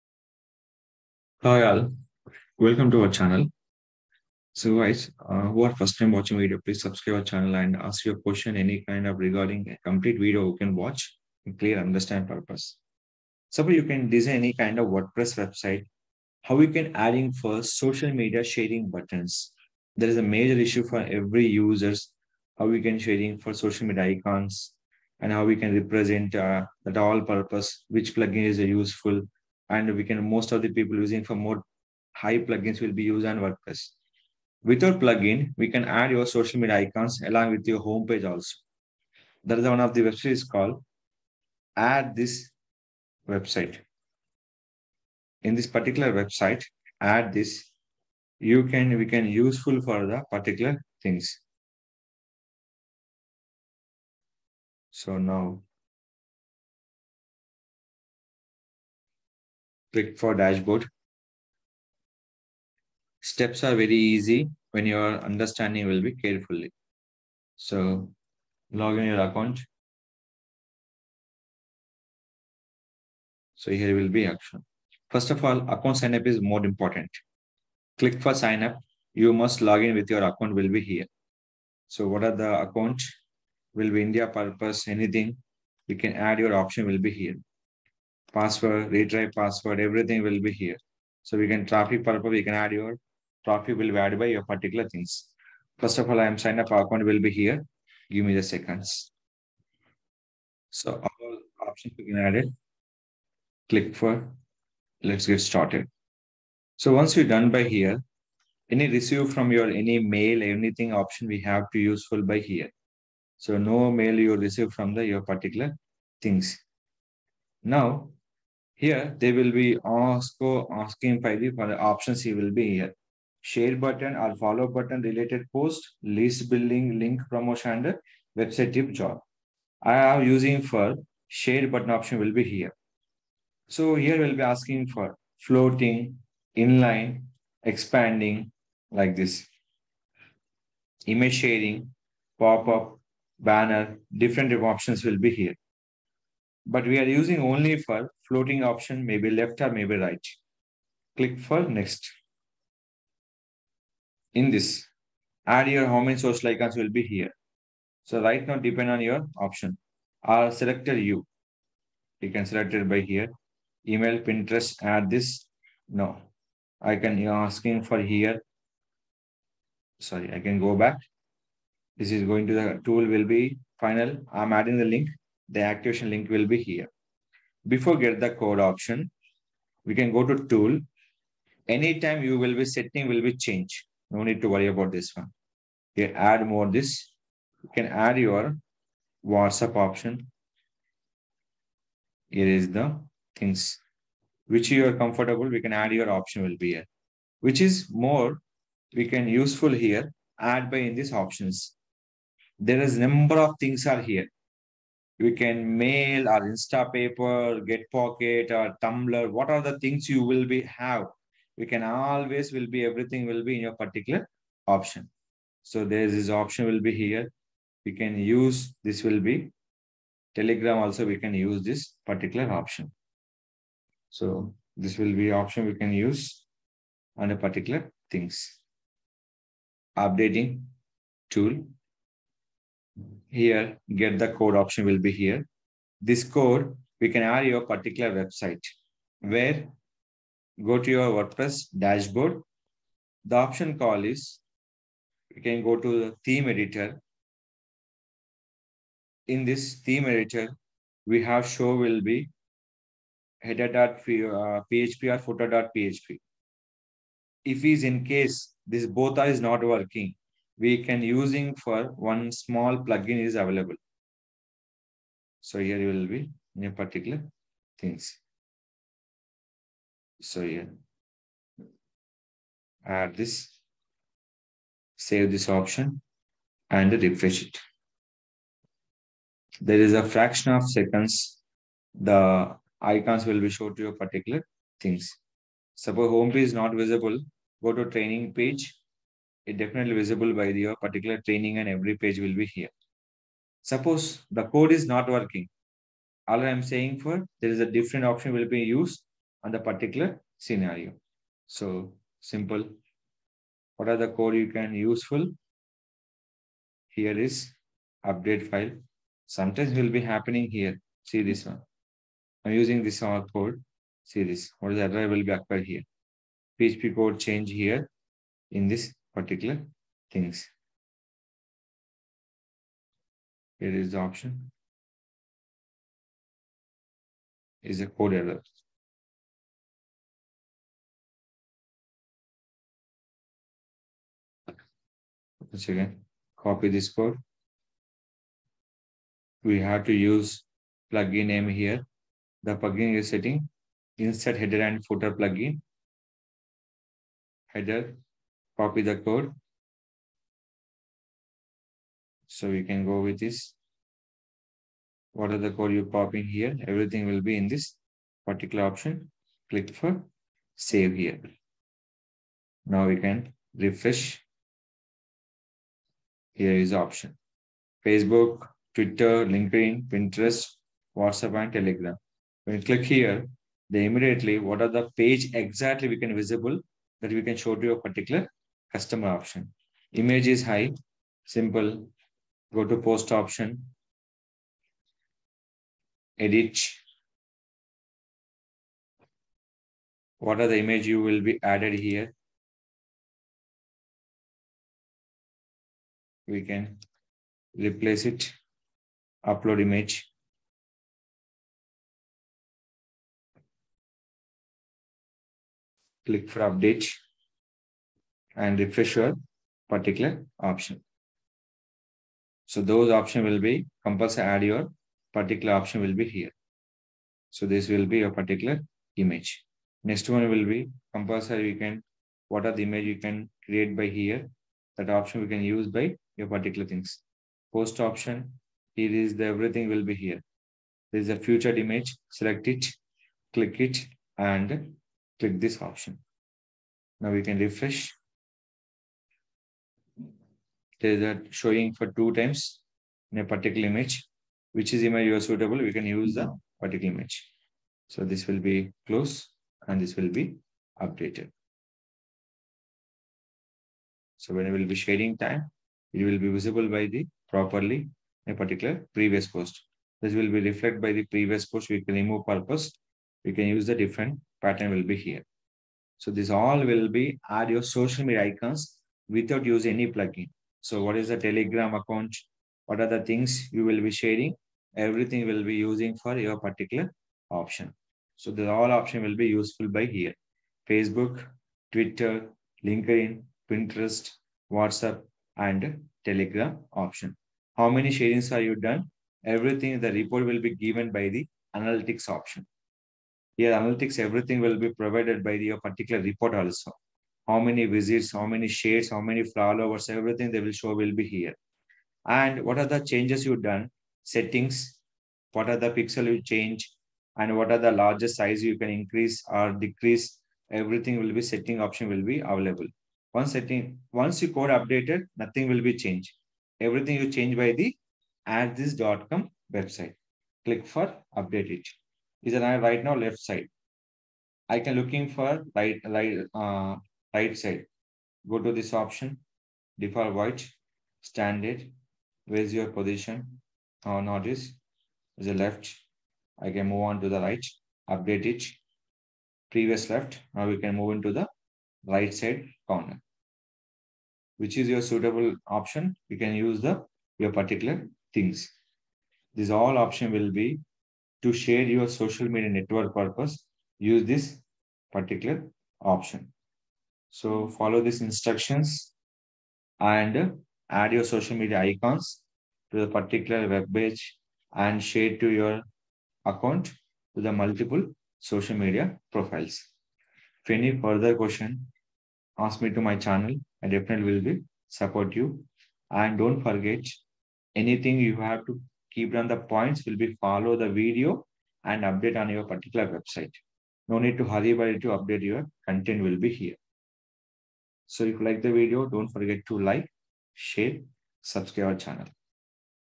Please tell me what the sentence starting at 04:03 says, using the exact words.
The option call is, you can go to the theme editor.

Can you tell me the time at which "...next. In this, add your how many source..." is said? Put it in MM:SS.
02:31.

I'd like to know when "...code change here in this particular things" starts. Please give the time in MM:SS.
05:16.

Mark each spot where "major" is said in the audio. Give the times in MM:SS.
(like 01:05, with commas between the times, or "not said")
00:20.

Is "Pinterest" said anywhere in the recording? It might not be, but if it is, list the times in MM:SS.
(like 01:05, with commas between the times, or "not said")
02:44, 06:09, 08:03.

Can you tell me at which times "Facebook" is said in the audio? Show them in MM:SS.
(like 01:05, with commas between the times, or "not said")
06:07, 08:00.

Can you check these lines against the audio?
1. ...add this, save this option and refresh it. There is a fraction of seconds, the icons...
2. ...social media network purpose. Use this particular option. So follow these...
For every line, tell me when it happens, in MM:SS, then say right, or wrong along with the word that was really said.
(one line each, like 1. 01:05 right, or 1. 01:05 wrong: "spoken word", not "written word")
1. 04:32 right
2. 09:11 right.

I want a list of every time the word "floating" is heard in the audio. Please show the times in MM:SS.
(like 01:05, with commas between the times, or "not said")
02:15, 02:28.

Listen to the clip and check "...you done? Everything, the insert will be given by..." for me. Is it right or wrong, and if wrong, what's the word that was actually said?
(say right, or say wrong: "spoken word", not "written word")
wrong: "report", not "insert".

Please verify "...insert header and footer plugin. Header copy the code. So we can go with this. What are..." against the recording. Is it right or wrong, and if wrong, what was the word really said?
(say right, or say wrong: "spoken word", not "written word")
right.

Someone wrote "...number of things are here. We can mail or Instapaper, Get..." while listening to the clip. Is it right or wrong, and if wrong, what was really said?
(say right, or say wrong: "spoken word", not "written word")
right.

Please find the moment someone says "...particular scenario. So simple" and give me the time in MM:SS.
04:59.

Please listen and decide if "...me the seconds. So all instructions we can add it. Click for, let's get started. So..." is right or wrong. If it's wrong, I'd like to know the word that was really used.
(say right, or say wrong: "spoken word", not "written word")
wrong: "options", not "instructions".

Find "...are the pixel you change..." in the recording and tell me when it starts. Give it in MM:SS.
08:25.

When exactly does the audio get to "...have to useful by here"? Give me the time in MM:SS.
01:51.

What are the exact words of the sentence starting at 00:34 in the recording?
Without plugin, we can add your social media icons along with your homepage also.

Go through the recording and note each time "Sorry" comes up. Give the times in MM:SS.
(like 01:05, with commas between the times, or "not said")
02:49.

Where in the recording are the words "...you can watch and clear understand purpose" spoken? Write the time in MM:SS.
00:10.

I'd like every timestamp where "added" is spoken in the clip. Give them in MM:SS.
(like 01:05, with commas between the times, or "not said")
01:33, 06:31.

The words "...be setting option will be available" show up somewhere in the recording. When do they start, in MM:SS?
08:31.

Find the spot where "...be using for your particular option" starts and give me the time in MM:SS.
07:55.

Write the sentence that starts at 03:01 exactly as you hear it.
Anytime you will be setting will be changed.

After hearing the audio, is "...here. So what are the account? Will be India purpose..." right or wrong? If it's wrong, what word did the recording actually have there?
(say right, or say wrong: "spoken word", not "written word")
right.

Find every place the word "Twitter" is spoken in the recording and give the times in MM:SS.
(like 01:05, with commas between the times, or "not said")
06:08, 08:01.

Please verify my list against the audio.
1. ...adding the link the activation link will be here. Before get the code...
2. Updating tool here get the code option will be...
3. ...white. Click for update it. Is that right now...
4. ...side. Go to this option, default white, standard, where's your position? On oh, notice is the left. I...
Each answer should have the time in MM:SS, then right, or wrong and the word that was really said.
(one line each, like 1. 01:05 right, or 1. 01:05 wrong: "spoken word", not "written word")
1. 02:54 right
2. 03:49 right
3. 08:39 wrong: "website", not "white"
4. 08:47 right.